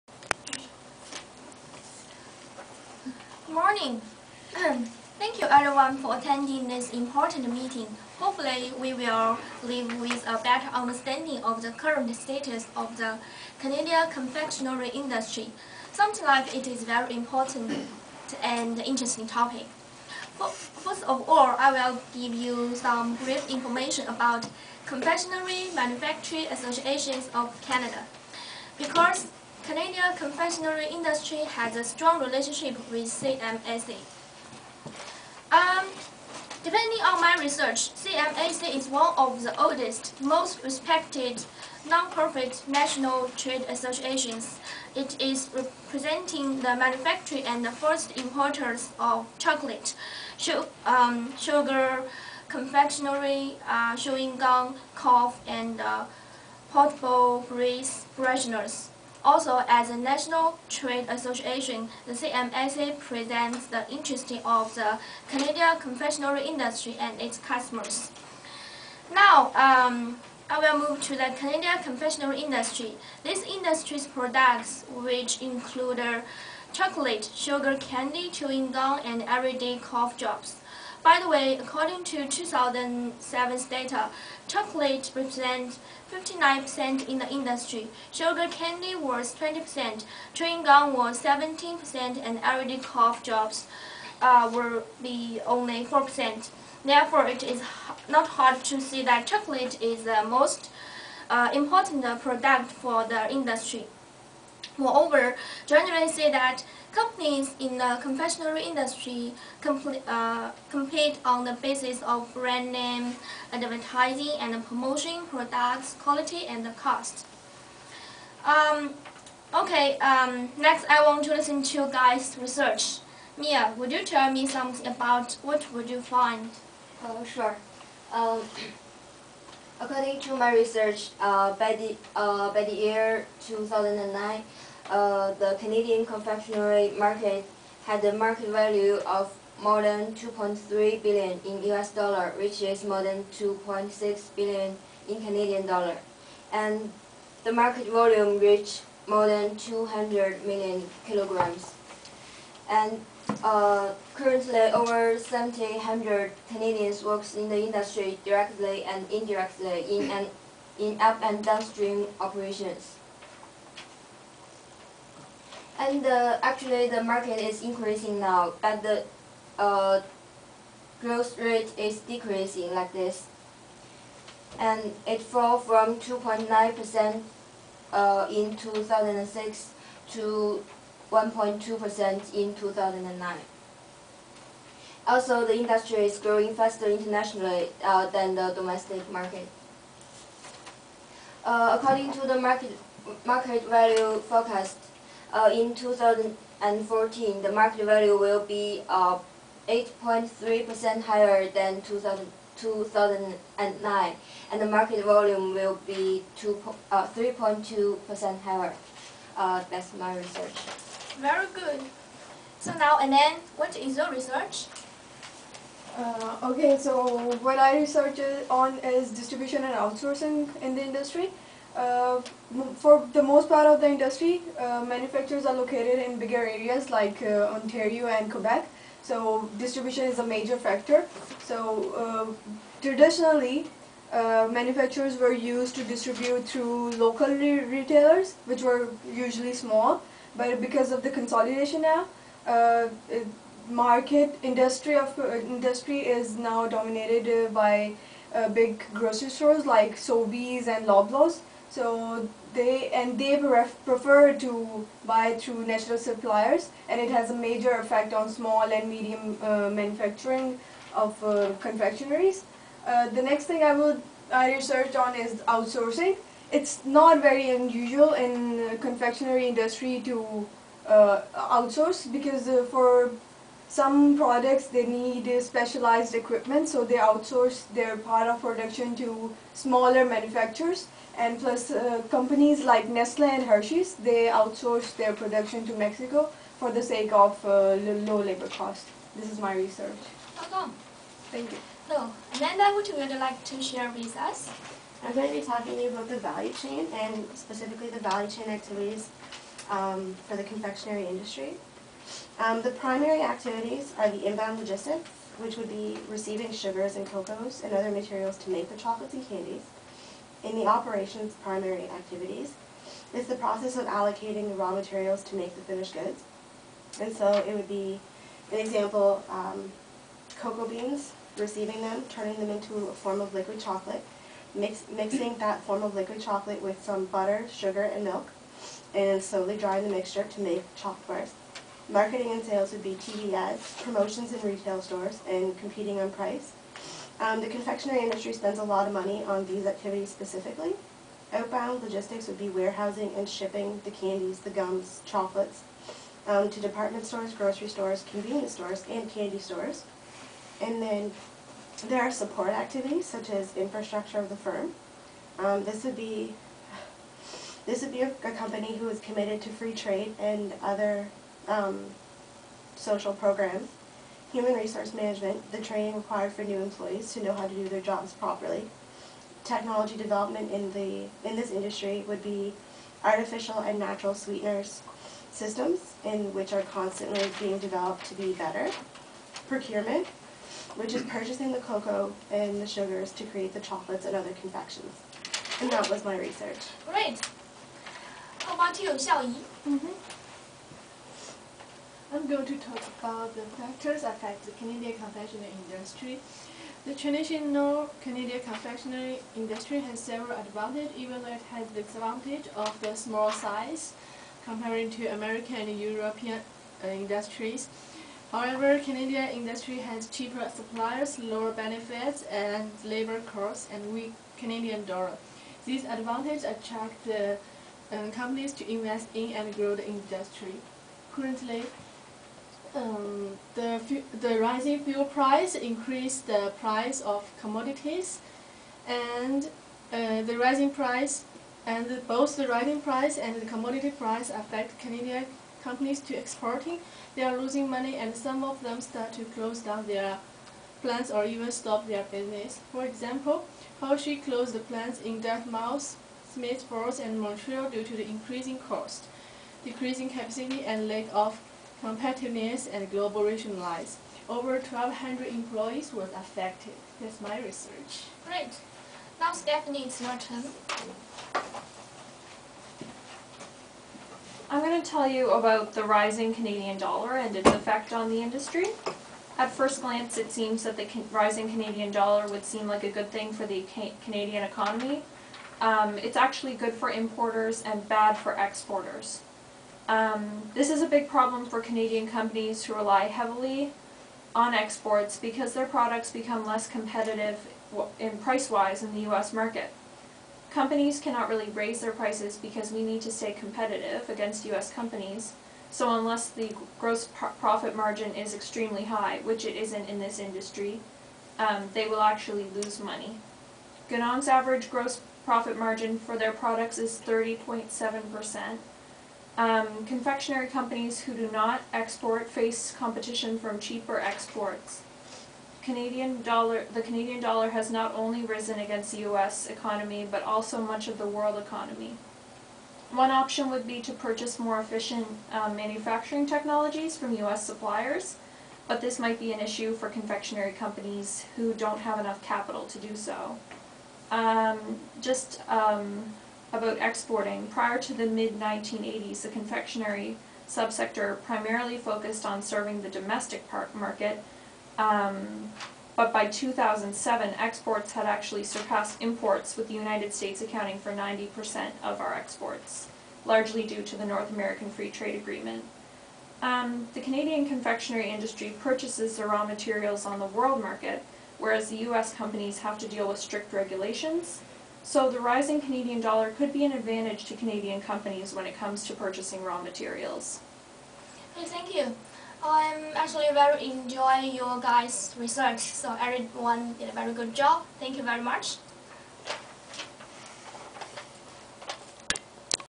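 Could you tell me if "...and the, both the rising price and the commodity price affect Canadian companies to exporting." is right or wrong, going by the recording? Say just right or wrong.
right.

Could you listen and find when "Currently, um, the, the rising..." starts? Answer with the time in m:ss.
7:01.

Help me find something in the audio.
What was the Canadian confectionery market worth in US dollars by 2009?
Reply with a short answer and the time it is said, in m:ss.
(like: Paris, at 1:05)
more than 2.3 billion, at 2:20.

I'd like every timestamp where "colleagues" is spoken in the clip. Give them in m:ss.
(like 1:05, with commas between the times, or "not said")
not said.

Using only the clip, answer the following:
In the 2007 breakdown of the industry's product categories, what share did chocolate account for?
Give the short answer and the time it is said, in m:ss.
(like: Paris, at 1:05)
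59%, at 1:26.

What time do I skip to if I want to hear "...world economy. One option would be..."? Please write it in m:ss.
8:41.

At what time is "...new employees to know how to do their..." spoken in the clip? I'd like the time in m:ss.
6:06.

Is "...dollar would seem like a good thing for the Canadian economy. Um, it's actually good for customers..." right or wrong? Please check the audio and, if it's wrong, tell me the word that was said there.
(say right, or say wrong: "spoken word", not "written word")
wrong: "importers", not "customers".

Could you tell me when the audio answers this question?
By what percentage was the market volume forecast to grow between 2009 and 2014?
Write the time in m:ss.
3:26.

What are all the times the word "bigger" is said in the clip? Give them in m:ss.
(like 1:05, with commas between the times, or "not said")
3:46.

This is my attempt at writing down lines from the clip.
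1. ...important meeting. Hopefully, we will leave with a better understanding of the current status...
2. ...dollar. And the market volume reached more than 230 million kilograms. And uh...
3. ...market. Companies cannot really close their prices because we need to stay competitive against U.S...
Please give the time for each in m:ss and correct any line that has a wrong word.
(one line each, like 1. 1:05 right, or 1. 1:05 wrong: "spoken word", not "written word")
1. 0:06 right
2. 2:25 wrong: "200", not "230"
3. 8:09 wrong: "raise", not "close".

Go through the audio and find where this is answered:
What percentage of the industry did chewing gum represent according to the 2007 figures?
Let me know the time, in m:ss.
1:31.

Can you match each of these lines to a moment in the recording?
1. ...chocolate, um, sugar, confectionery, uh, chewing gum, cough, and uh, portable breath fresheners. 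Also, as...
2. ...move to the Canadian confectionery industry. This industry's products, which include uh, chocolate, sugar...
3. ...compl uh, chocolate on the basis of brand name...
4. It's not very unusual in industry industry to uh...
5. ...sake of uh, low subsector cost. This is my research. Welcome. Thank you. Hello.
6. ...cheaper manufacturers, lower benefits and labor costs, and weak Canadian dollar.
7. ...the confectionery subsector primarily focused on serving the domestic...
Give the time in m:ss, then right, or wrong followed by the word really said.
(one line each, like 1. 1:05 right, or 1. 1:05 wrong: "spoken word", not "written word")
1. 0:49 right
2. 1:10 right
3. 1:49 wrong: "compete", not "chocolate"
4. 4:26 wrong: "confectionery", not "industry"
5. 4:46 wrong: "labor", not "subsector"
6. 6:50 wrong: "suppliers", not "manufacturers"
7. 8:59 right.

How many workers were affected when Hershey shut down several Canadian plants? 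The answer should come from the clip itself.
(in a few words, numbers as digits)
Over 1,200.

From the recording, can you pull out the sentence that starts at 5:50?
And then there are support activities such as infrastructure of the firm.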